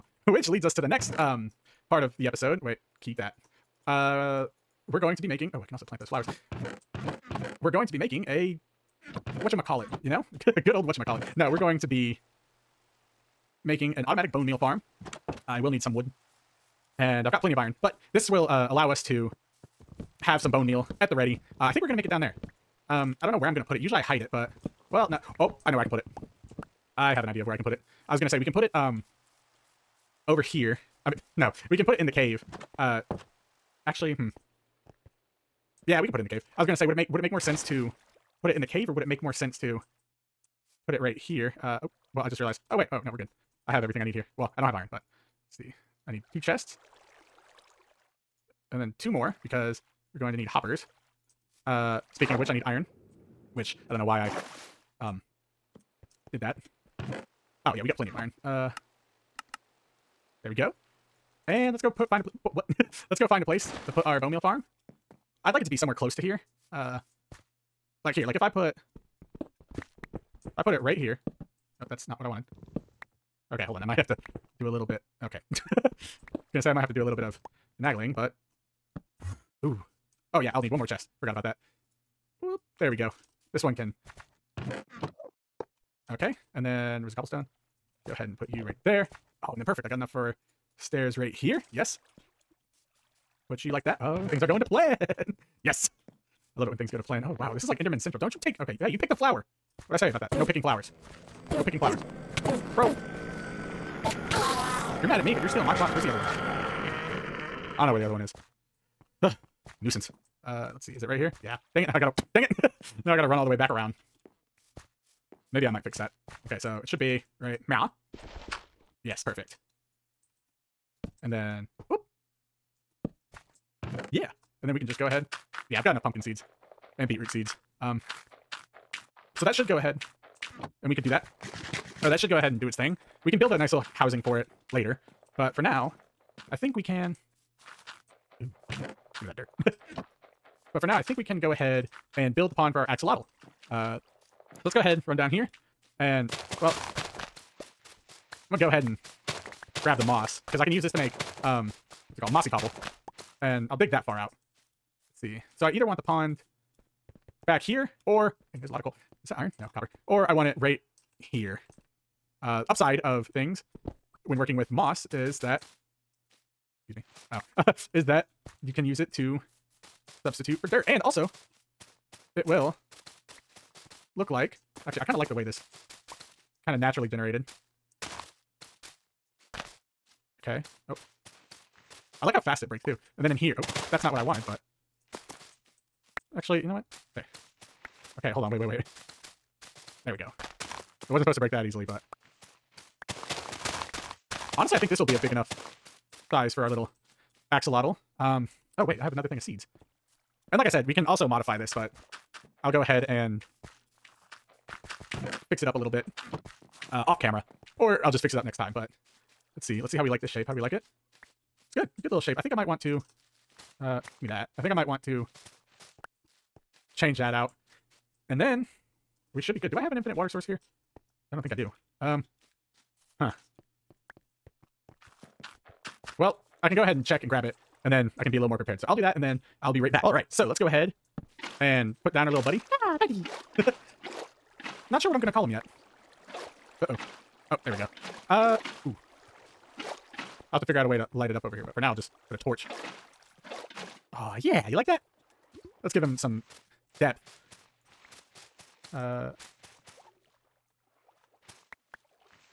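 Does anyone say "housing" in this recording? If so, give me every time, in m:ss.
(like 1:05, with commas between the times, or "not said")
2:13.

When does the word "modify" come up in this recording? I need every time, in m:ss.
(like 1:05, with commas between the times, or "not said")
3:21.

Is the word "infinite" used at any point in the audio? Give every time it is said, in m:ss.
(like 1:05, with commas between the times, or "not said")
3:39.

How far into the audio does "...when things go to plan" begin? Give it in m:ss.
1:36.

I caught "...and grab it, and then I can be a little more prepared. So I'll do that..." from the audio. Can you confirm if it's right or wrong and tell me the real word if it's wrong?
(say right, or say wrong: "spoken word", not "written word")
right.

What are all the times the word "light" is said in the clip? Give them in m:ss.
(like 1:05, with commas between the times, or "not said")
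4:01.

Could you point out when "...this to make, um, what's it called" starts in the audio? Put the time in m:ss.
2:30.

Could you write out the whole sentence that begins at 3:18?
Um, oh, wait, I have another thing of seeds.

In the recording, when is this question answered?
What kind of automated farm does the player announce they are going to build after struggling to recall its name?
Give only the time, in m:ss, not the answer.
0:14.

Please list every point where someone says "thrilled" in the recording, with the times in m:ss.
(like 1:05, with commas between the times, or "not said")
not said.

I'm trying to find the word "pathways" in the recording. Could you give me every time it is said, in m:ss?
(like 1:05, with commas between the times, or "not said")
not said.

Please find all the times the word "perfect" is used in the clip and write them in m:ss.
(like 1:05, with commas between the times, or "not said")
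1:29, 1:59.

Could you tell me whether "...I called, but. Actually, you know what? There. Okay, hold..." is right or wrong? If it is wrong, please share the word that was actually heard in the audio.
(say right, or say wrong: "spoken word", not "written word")
wrong: "wanted", not "called".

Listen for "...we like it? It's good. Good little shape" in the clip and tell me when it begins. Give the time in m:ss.
3:30.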